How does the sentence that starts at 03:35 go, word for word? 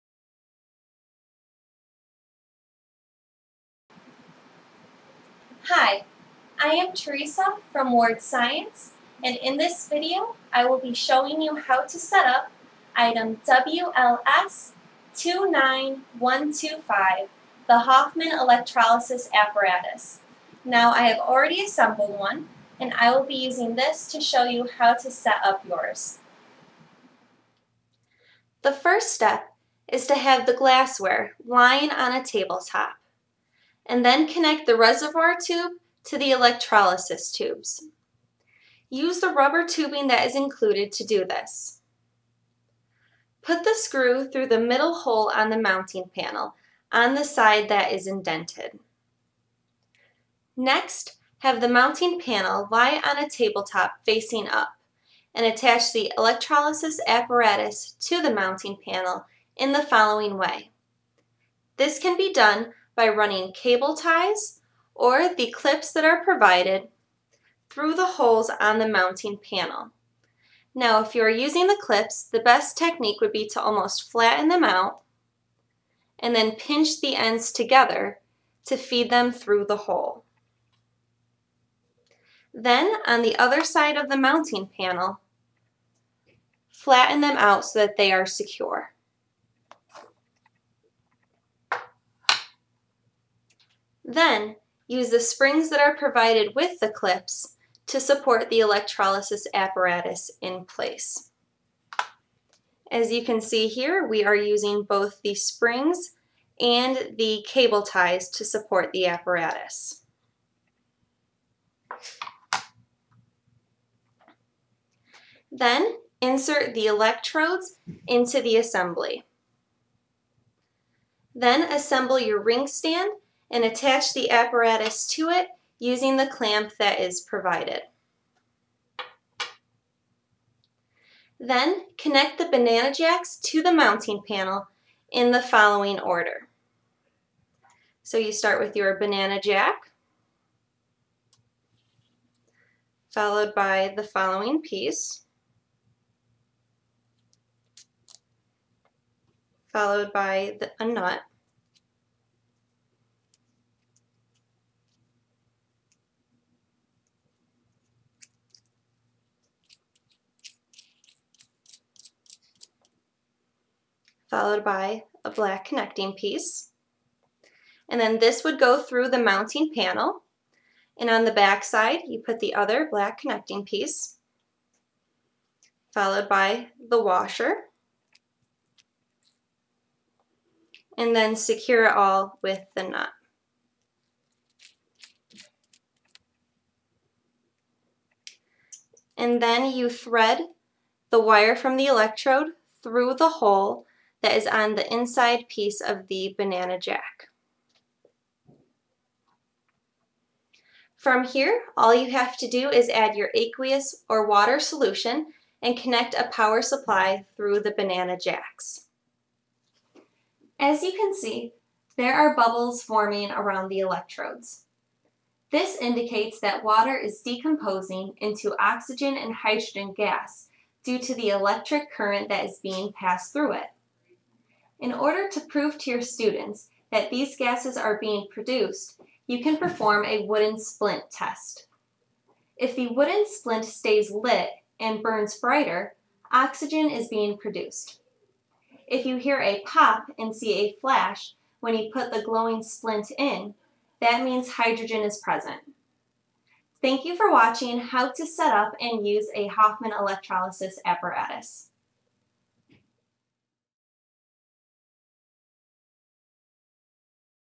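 This indicates that water is decomposing into oxygen and hydrogen gas due to the electric current that is being passed through it.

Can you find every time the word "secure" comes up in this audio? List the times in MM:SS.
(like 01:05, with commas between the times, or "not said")
01:28, 03:01.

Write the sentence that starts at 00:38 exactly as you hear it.
Use the rubber tubing that is included to do this.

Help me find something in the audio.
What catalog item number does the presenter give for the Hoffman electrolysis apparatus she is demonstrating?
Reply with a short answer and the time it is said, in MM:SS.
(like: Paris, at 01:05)
WLS 29125, at 00:13.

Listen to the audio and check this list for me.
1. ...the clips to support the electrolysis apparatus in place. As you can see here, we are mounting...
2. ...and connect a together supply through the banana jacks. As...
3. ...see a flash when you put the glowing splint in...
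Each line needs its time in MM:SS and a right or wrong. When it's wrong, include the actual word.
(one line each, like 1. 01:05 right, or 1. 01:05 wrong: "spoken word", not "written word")
1. 01:36 wrong: "using", not "mounting"
2. 03:25 wrong: "power", not "together"
3. 04:00 right.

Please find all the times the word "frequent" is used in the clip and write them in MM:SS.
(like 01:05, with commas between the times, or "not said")
not said.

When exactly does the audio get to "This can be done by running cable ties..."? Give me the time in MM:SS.
01:01.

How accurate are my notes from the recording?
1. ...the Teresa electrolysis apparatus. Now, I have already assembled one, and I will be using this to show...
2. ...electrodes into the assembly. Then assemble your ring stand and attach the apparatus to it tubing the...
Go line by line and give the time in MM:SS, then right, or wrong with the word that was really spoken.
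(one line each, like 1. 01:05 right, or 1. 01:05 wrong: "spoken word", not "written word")
1. 00:17 wrong: "Hoffman", not "Teresa"
2. 01:56 wrong: "using", not "tubing".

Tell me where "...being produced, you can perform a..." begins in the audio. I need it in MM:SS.
03:48.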